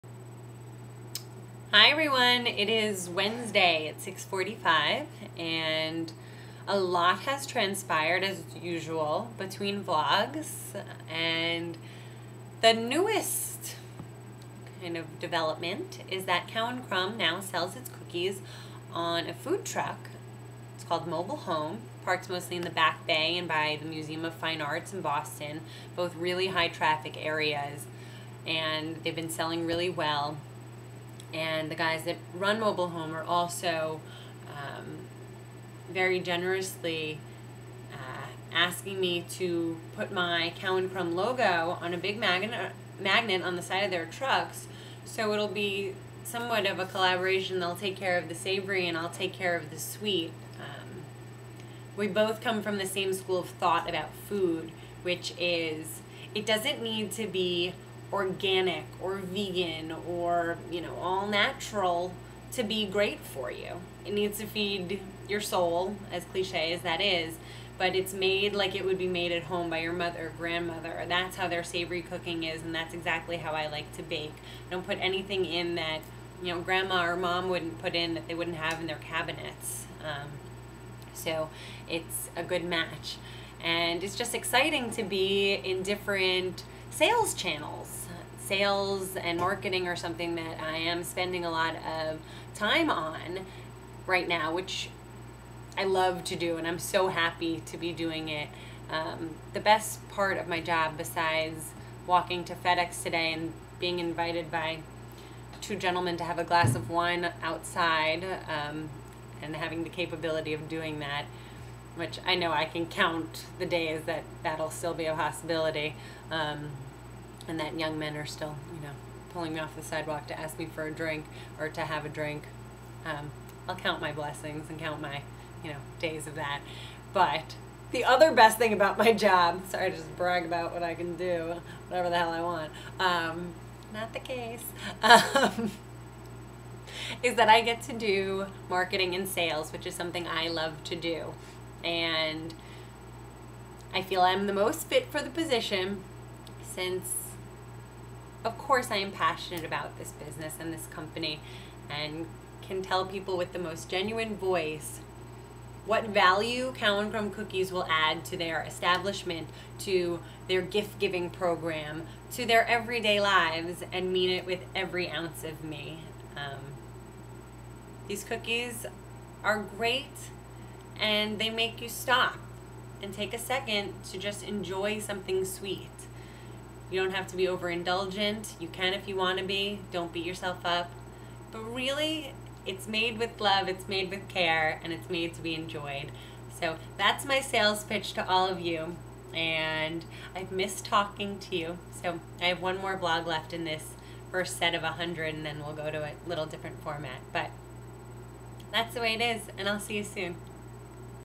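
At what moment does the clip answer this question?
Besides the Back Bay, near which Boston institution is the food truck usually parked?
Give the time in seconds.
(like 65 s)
23 s.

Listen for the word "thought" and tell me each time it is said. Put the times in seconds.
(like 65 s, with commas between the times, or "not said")
53 s.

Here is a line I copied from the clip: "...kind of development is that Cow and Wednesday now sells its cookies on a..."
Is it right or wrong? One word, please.
wrong.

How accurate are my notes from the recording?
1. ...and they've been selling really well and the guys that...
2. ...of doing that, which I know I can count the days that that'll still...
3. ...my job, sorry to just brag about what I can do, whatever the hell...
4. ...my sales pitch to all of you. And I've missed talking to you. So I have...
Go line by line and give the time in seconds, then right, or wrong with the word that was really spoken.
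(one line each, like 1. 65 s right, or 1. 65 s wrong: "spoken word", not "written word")
1. 28 s right
2. 110 s right
3. 128 s right
4. 187 s right.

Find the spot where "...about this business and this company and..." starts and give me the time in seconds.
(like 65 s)
149 s.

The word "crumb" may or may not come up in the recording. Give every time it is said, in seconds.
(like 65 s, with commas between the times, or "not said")
16 s, 40 s, 157 s.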